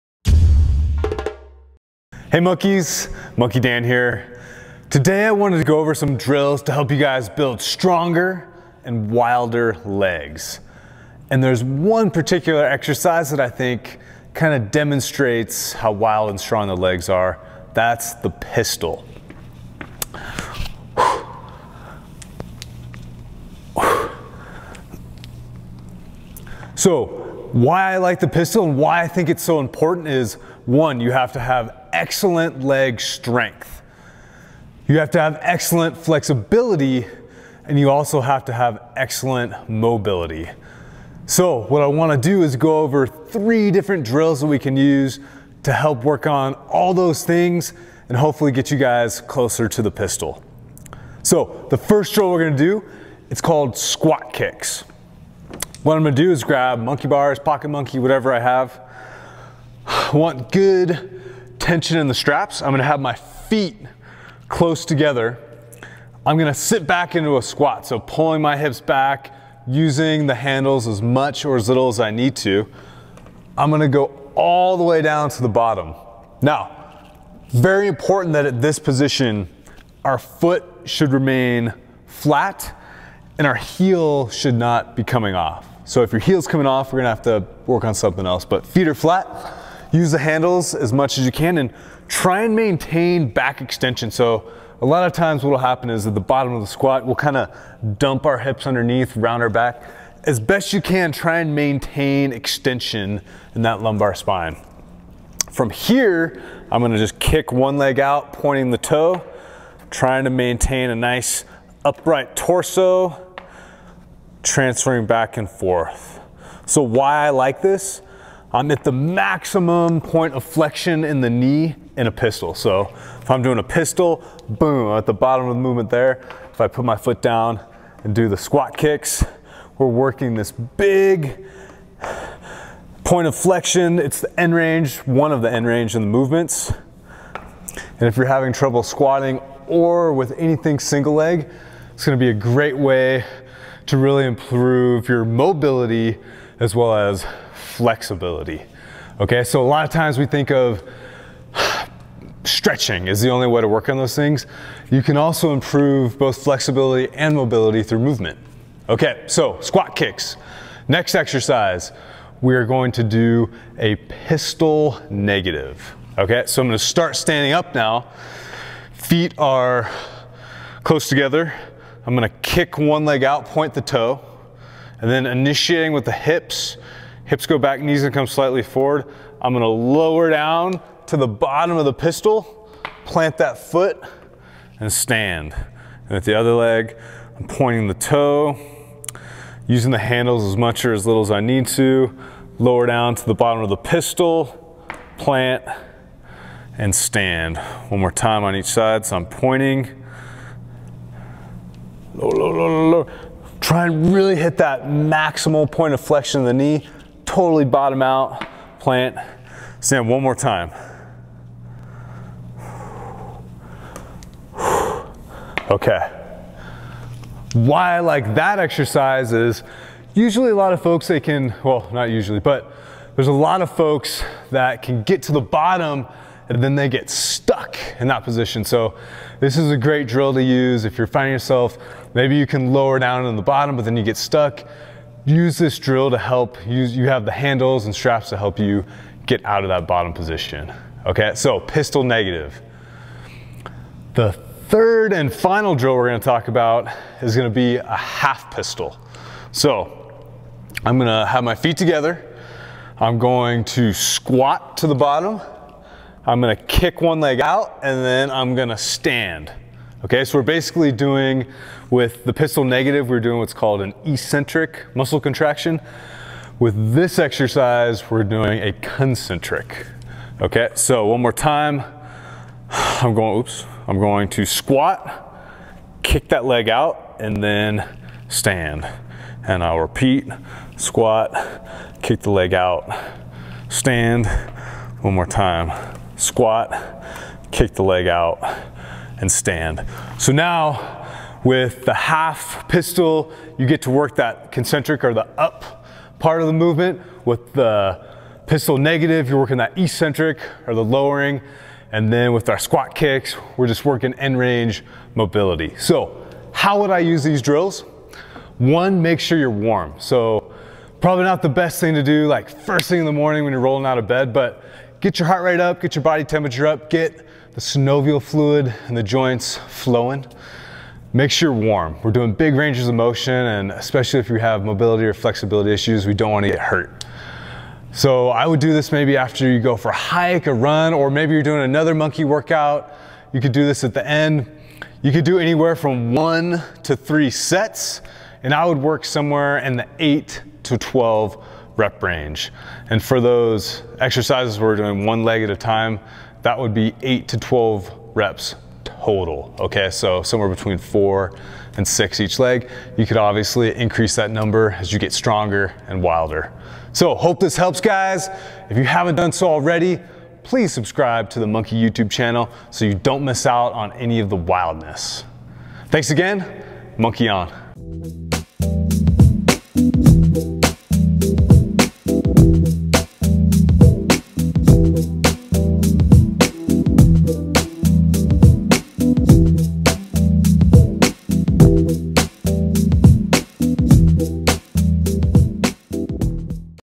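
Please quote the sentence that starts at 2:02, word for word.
So if I'm doing a pistol, boom, at the bottom of the movement there.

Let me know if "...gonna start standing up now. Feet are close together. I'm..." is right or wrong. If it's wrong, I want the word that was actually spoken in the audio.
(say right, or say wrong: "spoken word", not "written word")
right.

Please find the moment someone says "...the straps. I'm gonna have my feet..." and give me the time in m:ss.
1:02.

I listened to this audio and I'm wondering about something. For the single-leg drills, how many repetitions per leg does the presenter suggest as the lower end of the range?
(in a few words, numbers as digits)
4.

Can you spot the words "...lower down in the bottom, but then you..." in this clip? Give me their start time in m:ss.
3:52.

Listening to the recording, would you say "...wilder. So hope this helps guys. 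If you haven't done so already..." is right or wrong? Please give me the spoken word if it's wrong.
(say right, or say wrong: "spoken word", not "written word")
right.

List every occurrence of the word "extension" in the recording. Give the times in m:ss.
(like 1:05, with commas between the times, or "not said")
1:33, 1:42.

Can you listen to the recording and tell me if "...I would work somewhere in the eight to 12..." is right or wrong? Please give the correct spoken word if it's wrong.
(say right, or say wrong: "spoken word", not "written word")
right.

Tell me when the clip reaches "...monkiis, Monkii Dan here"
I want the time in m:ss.
0:02.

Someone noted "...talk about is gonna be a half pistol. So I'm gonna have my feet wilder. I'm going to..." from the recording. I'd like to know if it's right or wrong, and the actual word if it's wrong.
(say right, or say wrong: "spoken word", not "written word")
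wrong: "together", not "wilder".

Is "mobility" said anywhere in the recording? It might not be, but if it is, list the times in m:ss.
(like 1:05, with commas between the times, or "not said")
0:39, 2:25, 2:37, 5:05, 5:24.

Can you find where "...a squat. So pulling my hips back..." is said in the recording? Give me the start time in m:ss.
1:07.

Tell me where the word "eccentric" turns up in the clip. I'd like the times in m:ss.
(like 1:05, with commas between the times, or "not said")
4:24, 4:59.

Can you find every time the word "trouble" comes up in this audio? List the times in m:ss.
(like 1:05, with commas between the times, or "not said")
2:18.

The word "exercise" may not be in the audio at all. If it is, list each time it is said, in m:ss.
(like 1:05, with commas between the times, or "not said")
0:12, 2:41, 3:38, 4:27, 5:43.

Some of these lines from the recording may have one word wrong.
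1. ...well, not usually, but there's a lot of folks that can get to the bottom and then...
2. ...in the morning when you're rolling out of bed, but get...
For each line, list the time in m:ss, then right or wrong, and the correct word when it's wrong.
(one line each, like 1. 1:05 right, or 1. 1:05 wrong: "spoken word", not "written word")
1. 3:41 right
2. 5:12 right.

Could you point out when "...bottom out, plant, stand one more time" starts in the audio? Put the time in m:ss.
3:27.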